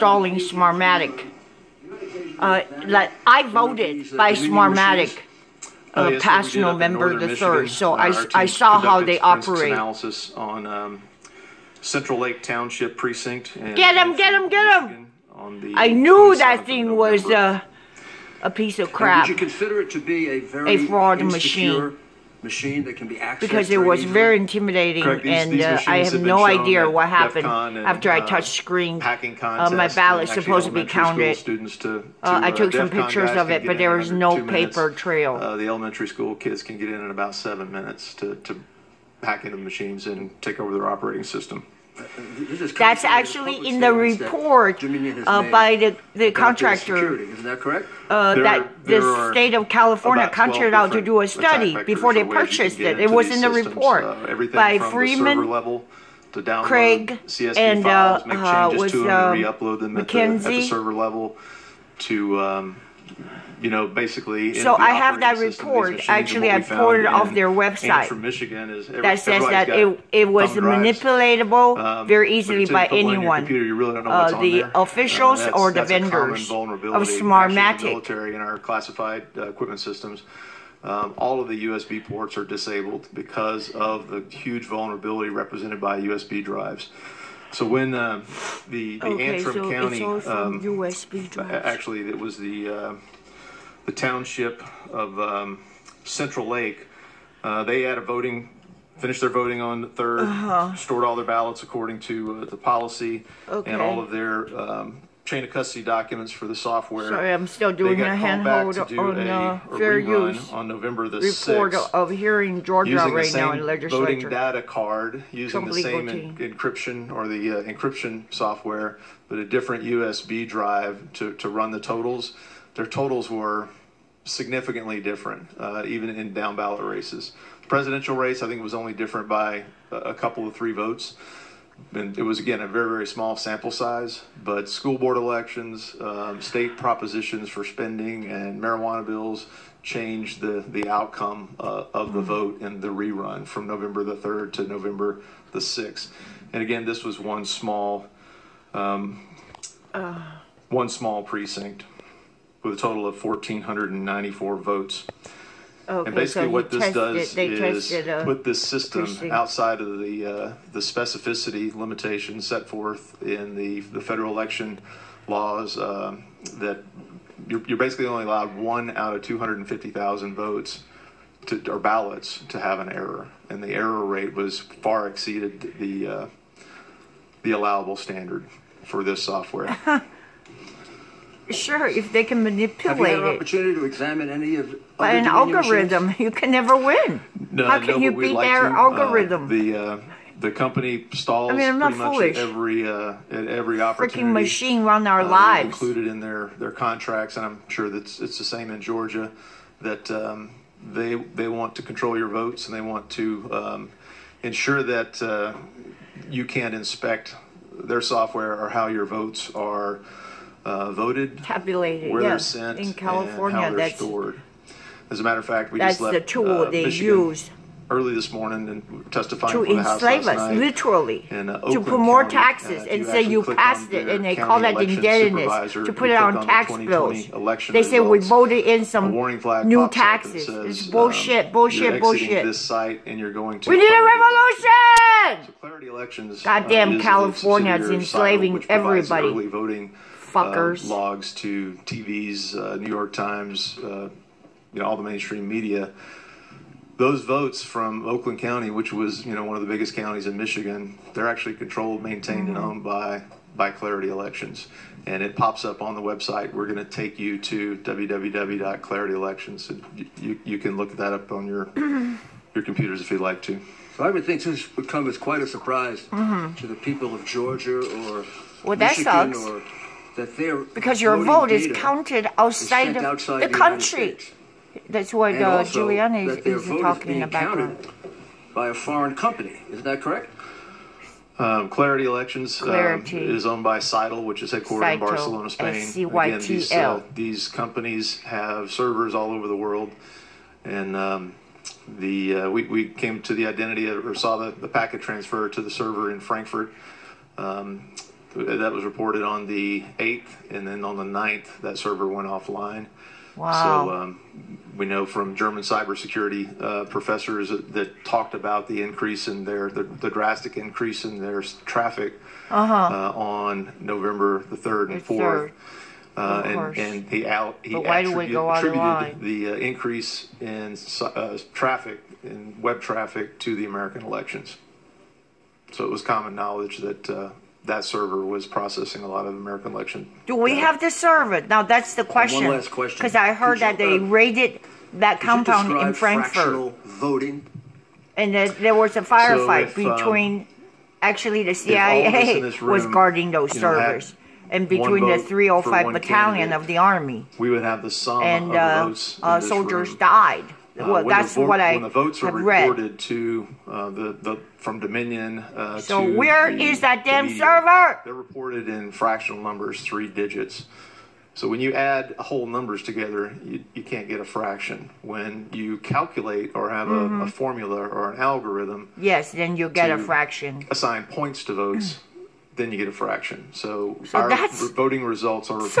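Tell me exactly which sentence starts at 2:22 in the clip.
vote in the rerun from November the 3rd to November the 6th.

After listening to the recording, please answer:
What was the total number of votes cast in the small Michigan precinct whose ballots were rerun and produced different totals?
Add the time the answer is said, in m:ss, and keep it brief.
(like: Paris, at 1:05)
1,494, at 2:33.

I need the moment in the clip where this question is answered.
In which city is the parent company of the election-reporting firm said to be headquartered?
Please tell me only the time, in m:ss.
4:44.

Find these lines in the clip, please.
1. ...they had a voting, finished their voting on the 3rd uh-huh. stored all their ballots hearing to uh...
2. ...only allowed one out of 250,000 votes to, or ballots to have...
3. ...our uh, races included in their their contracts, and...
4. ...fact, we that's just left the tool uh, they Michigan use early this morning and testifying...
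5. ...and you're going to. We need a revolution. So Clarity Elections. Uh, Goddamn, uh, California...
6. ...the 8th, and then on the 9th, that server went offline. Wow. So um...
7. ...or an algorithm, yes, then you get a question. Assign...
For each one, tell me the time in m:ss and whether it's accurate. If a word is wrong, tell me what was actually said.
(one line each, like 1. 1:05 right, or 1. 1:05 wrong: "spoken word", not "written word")
1. 1:37 wrong: "according", not "hearing"
2. 2:48 right
3. 3:15 wrong: "lives", not "races"
4. 3:35 right
5. 3:53 right
6. 4:59 right
7. 6:07 wrong: "fraction", not "question".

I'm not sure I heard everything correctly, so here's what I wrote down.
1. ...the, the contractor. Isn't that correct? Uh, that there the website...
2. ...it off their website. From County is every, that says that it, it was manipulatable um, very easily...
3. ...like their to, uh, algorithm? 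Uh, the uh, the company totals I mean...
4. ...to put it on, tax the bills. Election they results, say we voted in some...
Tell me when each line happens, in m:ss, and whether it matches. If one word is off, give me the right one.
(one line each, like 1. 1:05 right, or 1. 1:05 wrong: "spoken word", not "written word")
1. 0:45 wrong: "state", not "website"
2. 1:06 wrong: "Michigan", not "County"
3. 3:08 wrong: "stalls", not "totals"
4. 3:45 right.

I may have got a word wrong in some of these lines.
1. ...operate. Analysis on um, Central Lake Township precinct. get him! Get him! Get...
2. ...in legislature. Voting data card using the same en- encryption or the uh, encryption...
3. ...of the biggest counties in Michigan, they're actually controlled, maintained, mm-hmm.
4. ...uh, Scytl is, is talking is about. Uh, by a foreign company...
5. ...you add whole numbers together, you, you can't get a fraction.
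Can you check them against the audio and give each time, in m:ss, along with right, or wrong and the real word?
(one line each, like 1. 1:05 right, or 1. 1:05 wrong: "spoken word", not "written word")
1. 0:09 right
2. 1:53 right
3. 4:09 right
4. 4:35 wrong: "Giuliani", not "Scytl"
5. 6:01 right.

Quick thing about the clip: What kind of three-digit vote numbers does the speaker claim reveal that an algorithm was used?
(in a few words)
Fractional voting.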